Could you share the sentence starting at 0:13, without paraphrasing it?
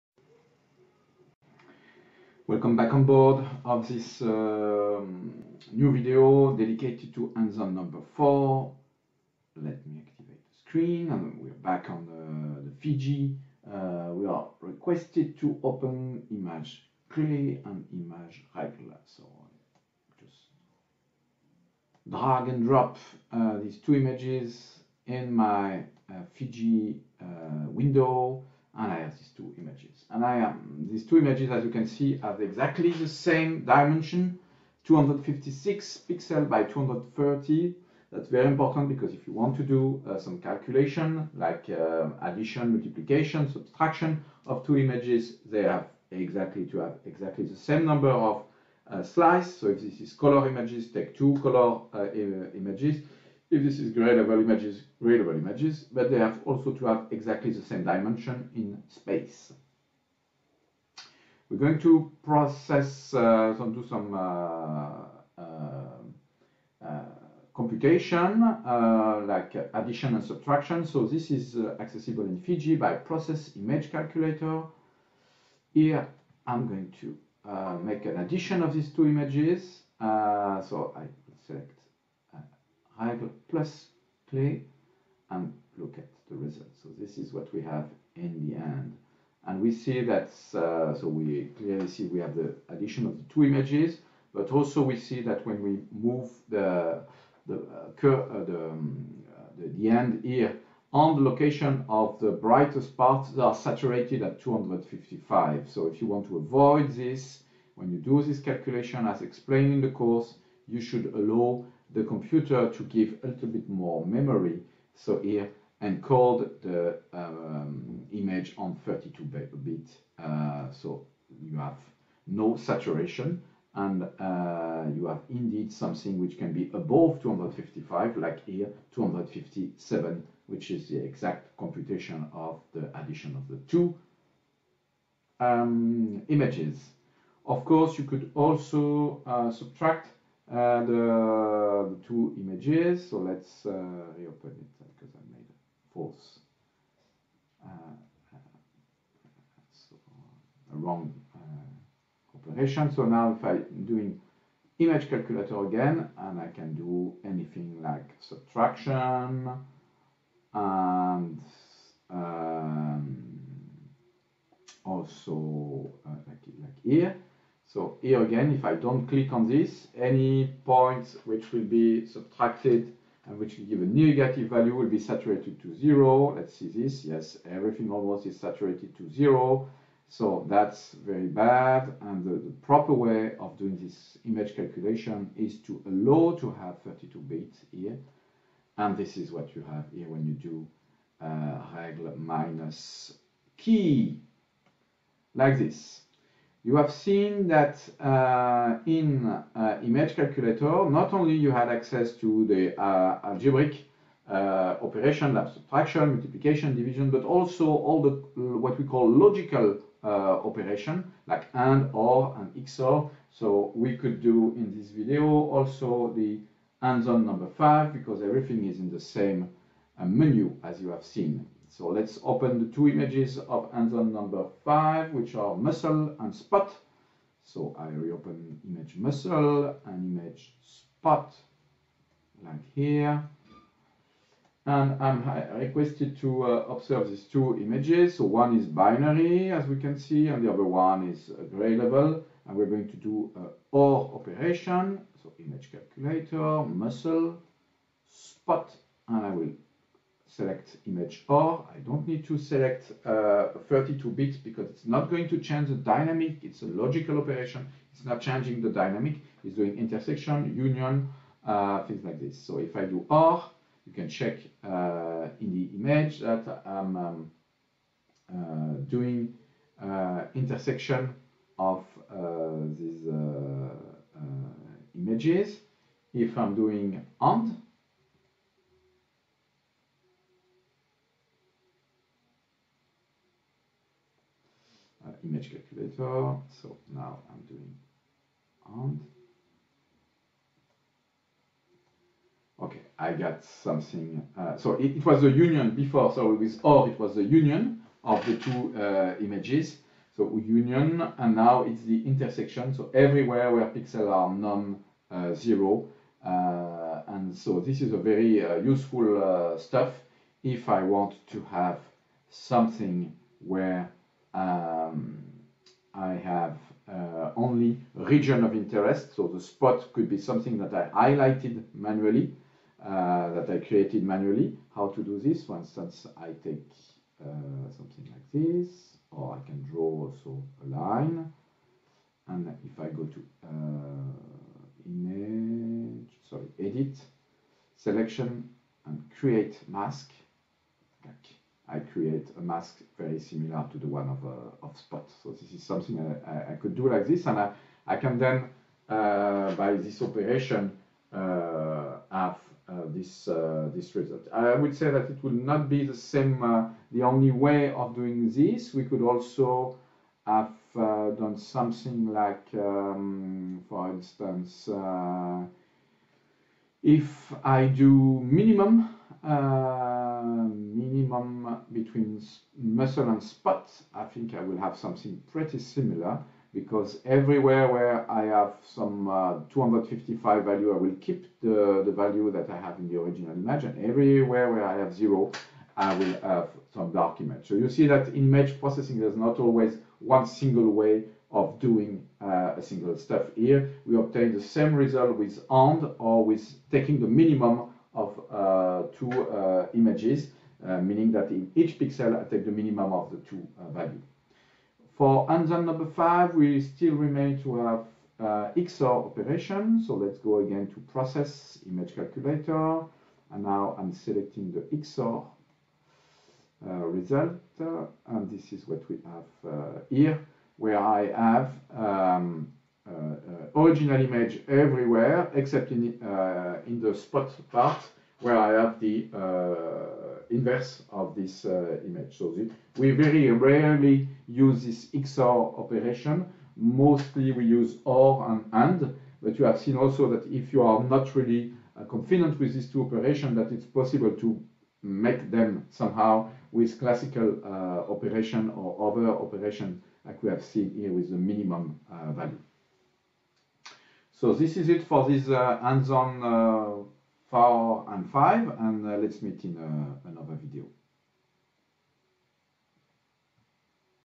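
Uh, we are requested to open image clearly and image regular.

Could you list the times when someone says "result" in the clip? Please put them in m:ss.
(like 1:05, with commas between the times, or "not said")
1:26, 5:53, 6:34, 6:56.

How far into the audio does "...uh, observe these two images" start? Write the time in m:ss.
3:56.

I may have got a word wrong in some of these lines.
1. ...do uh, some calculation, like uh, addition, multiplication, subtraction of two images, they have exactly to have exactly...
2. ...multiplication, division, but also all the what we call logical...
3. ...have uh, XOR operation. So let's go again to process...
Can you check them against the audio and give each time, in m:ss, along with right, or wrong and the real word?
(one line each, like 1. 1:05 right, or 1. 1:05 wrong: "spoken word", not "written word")
1. 0:39 right
2. 3:26 right
3. 6:47 right.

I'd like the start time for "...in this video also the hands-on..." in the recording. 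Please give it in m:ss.
3:34.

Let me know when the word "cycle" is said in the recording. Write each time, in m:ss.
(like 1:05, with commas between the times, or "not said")
not said.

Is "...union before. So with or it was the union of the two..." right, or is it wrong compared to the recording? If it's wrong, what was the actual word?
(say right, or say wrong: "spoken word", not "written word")
right.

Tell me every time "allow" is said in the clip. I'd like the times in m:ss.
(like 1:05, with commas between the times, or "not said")
1:51, 3:05.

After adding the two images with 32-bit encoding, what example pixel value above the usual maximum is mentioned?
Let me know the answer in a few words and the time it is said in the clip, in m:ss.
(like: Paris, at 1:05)
257, at 2:08.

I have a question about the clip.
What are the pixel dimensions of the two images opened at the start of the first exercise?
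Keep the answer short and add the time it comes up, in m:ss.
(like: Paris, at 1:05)
256 by 230, at 0:34.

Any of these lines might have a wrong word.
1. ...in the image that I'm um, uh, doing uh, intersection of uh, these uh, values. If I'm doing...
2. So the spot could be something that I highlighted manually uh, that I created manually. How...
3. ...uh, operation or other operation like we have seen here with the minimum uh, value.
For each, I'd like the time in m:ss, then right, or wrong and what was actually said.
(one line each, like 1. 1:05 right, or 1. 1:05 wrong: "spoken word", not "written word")
1. 4:25 wrong: "images", not "values"
2. 5:19 right
3. 7:27 right.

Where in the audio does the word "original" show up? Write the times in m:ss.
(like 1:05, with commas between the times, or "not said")
6:22, 7:03.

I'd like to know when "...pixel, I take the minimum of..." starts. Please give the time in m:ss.
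6:41.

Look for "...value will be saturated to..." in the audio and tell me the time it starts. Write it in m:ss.
2:54.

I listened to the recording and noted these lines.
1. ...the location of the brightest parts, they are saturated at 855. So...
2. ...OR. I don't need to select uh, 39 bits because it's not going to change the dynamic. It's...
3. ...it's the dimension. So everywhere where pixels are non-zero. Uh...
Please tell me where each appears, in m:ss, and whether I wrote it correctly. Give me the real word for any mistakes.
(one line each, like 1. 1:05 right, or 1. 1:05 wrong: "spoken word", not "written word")
1. 1:41 wrong: "255", not "855"
2. 4:11 wrong: "32", not "39"
3. 5:01 wrong: "intersection", not "dimension".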